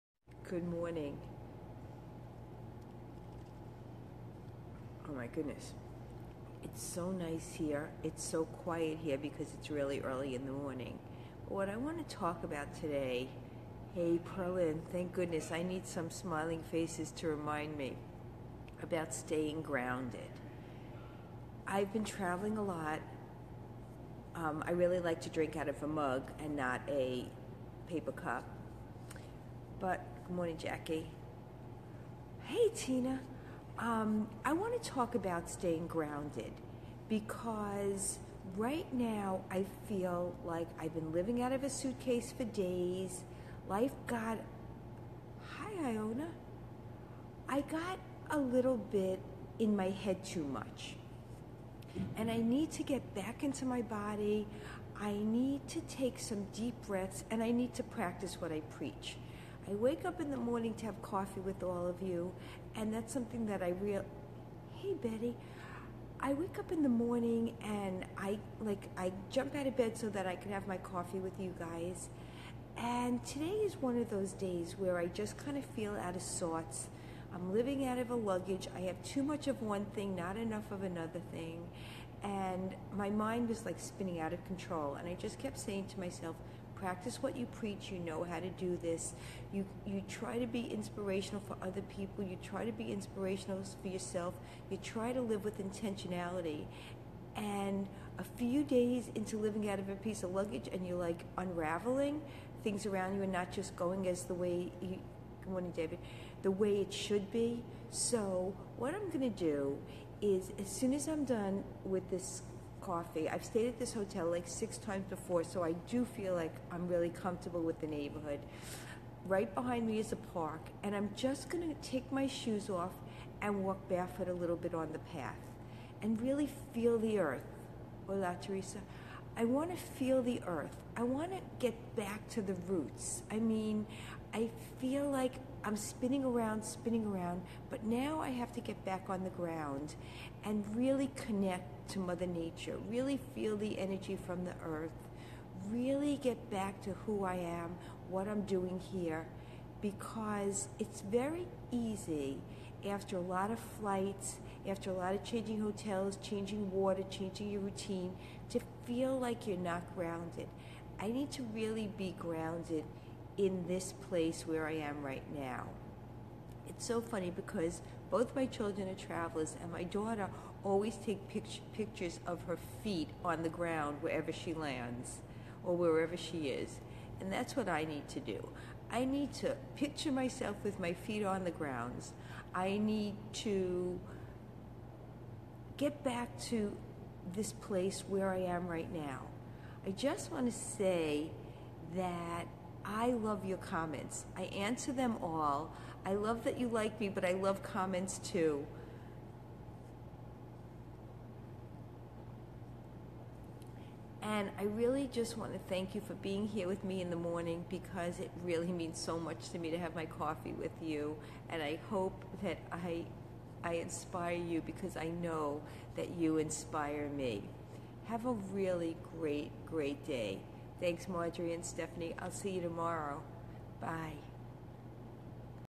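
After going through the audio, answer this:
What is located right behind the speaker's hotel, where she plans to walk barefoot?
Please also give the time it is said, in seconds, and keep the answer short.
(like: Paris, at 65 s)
a park, at 120 s.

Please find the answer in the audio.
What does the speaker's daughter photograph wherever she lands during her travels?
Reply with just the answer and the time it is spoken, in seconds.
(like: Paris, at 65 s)
her feet, at 172 s.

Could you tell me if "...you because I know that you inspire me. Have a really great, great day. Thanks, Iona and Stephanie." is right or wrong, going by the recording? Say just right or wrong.
wrong.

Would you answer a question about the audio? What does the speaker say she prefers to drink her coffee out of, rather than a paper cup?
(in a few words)
a mug.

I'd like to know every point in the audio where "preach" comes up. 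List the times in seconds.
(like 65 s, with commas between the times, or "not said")
58 s, 87 s.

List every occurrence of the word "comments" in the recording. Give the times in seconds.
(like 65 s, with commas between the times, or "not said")
193 s, 197 s.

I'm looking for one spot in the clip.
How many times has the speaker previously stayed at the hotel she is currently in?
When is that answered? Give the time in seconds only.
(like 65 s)
114 s.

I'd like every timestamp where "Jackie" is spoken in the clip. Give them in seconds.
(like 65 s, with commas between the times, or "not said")
30 s.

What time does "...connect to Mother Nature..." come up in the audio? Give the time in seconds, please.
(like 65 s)
141 s.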